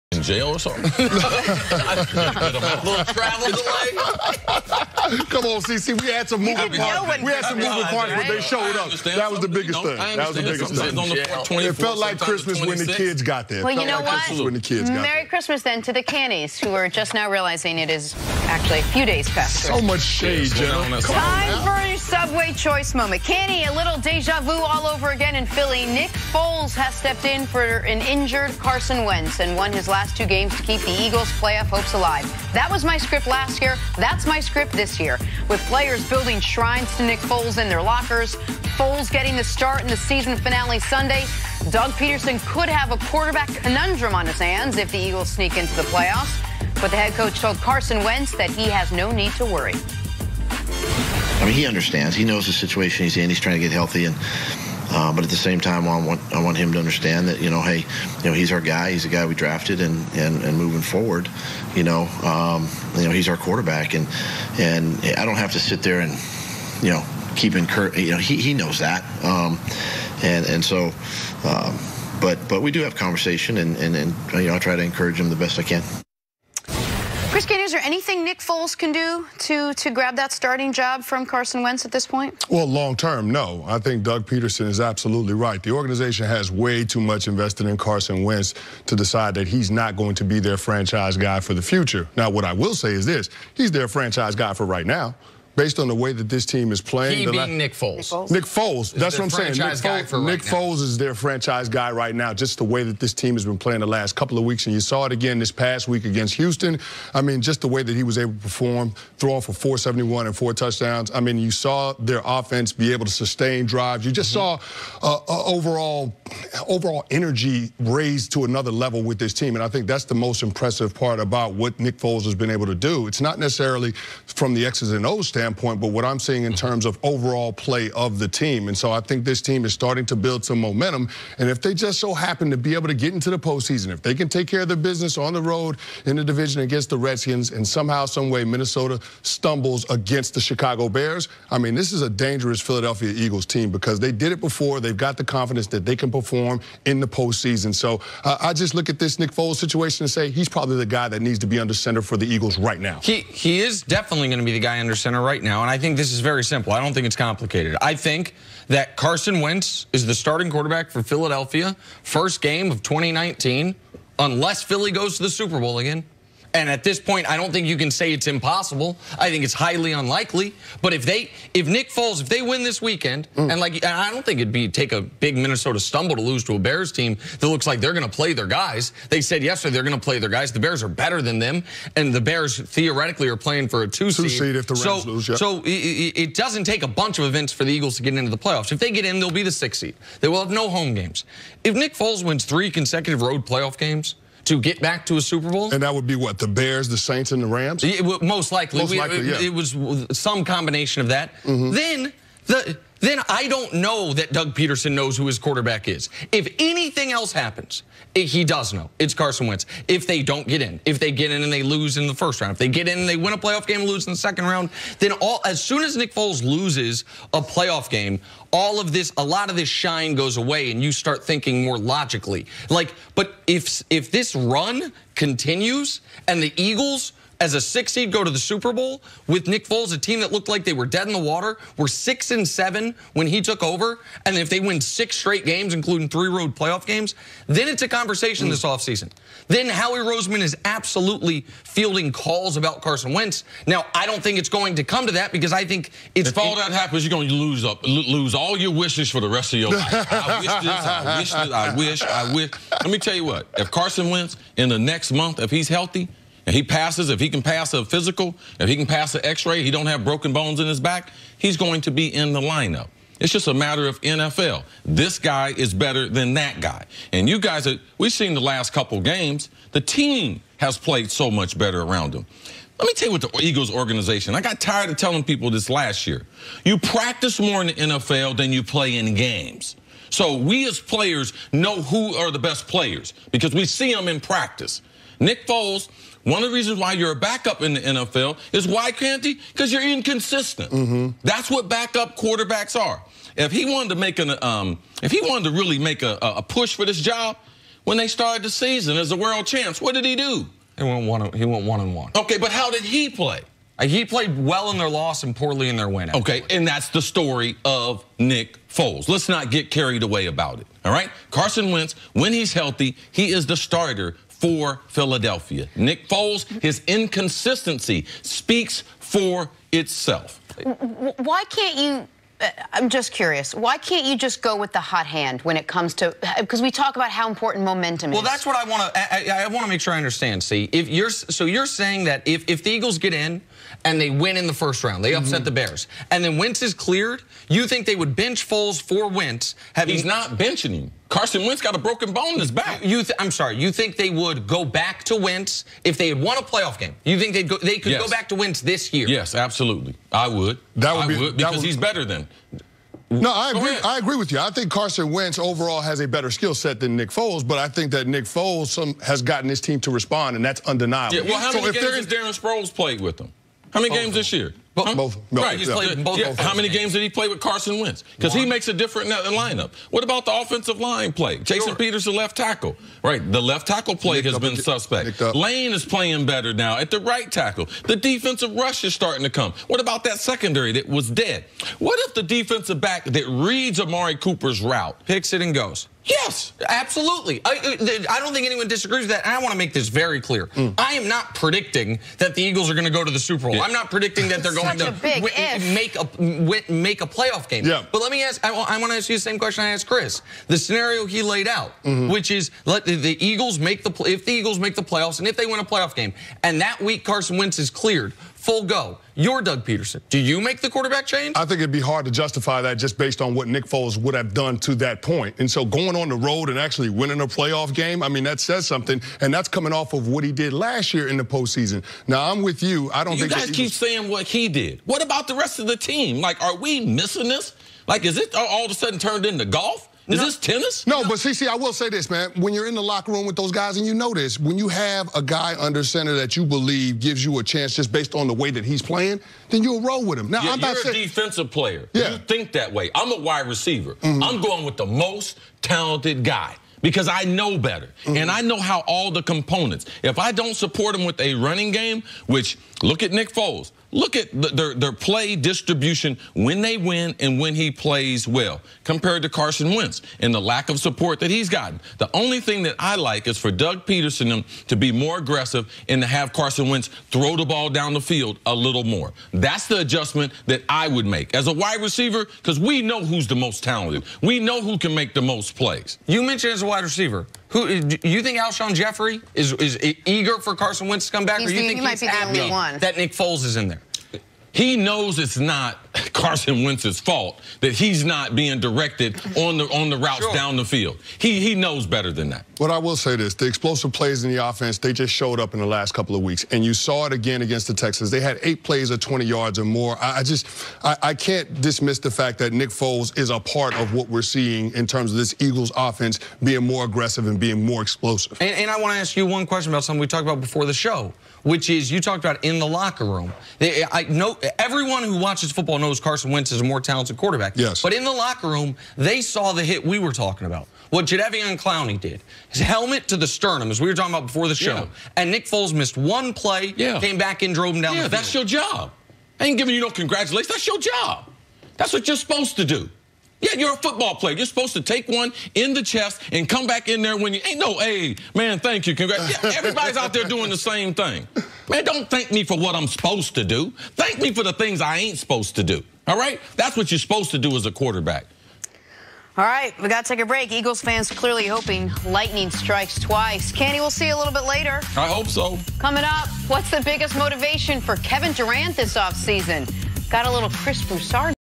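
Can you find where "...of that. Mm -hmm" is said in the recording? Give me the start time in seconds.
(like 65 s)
201 s.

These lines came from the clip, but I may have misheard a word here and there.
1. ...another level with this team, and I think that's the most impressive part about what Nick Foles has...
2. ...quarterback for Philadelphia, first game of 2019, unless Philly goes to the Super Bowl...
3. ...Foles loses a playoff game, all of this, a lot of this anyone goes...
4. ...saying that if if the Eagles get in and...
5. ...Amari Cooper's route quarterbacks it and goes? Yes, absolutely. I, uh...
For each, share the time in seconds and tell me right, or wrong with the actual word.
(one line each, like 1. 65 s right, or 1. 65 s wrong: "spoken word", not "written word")
1. 118 s right
2. 160 s right
3. 216 s wrong: "shine", not "anyone"
4. 331 s right
5. 383 s wrong: "picks", not "quarterbacks".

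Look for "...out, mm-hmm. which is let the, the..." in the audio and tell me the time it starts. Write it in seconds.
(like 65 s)
401 s.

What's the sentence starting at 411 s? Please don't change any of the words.
I think it'd be hard to justify that just based on what Nick Foles would have done to that point.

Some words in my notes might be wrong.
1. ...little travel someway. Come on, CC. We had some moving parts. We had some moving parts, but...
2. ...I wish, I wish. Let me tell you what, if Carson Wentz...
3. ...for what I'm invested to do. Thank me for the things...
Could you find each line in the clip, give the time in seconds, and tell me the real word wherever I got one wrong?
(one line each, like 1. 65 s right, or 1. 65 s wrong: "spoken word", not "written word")
1. 2 s wrong: "delay", not "someway"
2. 251 s right
3. 542 s wrong: "supposed", not "invested".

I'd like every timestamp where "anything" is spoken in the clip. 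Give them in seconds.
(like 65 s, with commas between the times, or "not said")
77 s, 206 s.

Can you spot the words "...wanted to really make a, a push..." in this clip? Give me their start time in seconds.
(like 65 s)
295 s.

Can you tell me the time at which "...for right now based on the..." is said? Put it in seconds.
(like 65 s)
94 s.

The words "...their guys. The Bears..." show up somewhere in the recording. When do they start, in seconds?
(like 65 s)
180 s.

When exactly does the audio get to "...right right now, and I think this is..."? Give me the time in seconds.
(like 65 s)
155 s.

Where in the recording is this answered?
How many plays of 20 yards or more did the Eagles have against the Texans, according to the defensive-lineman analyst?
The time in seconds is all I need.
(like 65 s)
498 s.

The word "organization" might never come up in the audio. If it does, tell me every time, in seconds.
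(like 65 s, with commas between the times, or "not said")
85 s, 273 s.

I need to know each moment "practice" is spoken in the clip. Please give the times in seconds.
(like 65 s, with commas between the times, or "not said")
276 s, 284 s.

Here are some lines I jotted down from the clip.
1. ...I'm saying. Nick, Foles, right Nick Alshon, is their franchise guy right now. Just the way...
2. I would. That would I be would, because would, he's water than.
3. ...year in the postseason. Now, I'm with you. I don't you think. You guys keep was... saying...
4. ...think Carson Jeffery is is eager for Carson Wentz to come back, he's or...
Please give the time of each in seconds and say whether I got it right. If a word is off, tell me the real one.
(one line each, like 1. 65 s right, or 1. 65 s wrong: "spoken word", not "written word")
1. 99 s wrong: "Foles", not "Alshon"
2. 350 s wrong: "better", not "water"
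3. 420 s right
4. 478 s wrong: "Alshon", not "Carson".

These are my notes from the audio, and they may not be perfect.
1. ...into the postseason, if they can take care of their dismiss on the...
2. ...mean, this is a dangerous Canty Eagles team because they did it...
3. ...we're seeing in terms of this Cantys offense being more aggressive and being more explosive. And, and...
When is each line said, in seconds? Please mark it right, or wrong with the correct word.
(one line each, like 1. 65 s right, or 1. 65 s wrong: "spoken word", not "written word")
1. 133 s wrong: "business", not "dismiss"
2. 141 s wrong: "Philadelphia", not "Canty"
3. 504 s wrong: "Eagles", not "Cantys".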